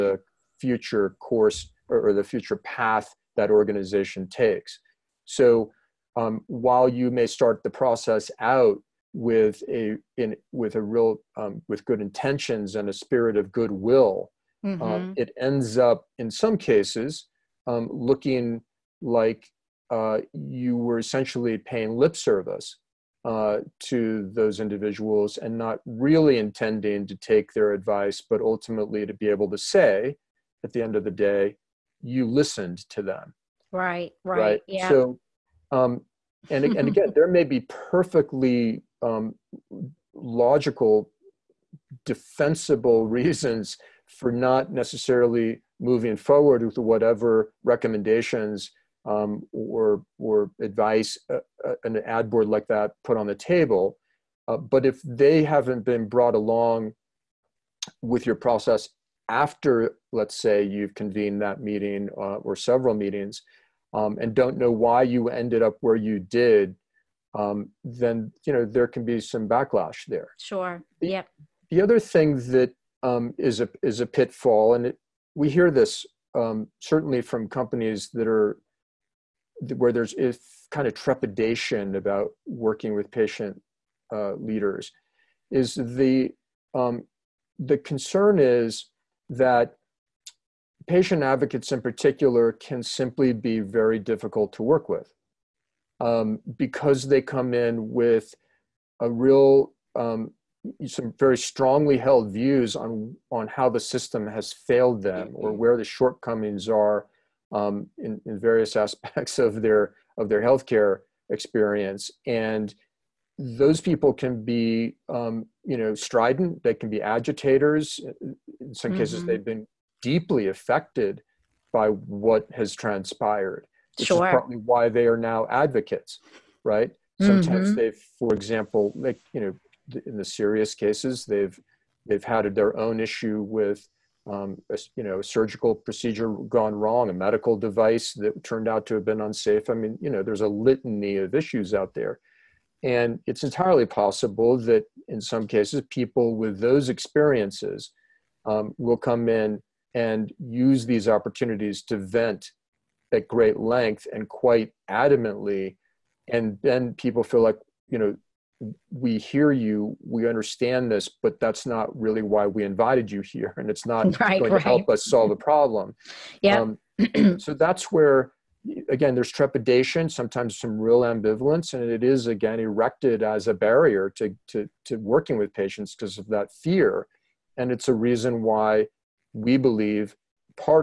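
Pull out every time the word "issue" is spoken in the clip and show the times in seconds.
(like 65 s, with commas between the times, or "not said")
133 s, 141 s.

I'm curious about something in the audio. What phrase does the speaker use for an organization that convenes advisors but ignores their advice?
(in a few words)
paying lip service.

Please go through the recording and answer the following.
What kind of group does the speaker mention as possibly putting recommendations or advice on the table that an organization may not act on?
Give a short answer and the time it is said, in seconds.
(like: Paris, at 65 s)
ad board, at 52 s.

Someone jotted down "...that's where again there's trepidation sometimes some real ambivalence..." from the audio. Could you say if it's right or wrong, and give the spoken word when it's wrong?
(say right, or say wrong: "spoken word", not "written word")
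right.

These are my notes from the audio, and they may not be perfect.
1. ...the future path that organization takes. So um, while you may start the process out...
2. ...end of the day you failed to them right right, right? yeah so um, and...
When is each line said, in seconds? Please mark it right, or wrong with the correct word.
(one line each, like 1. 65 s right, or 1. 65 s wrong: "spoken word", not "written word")
1. 2 s right
2. 30 s wrong: "listened", not "failed".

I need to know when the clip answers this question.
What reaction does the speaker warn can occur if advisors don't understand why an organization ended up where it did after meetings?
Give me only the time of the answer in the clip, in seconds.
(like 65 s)
69 s.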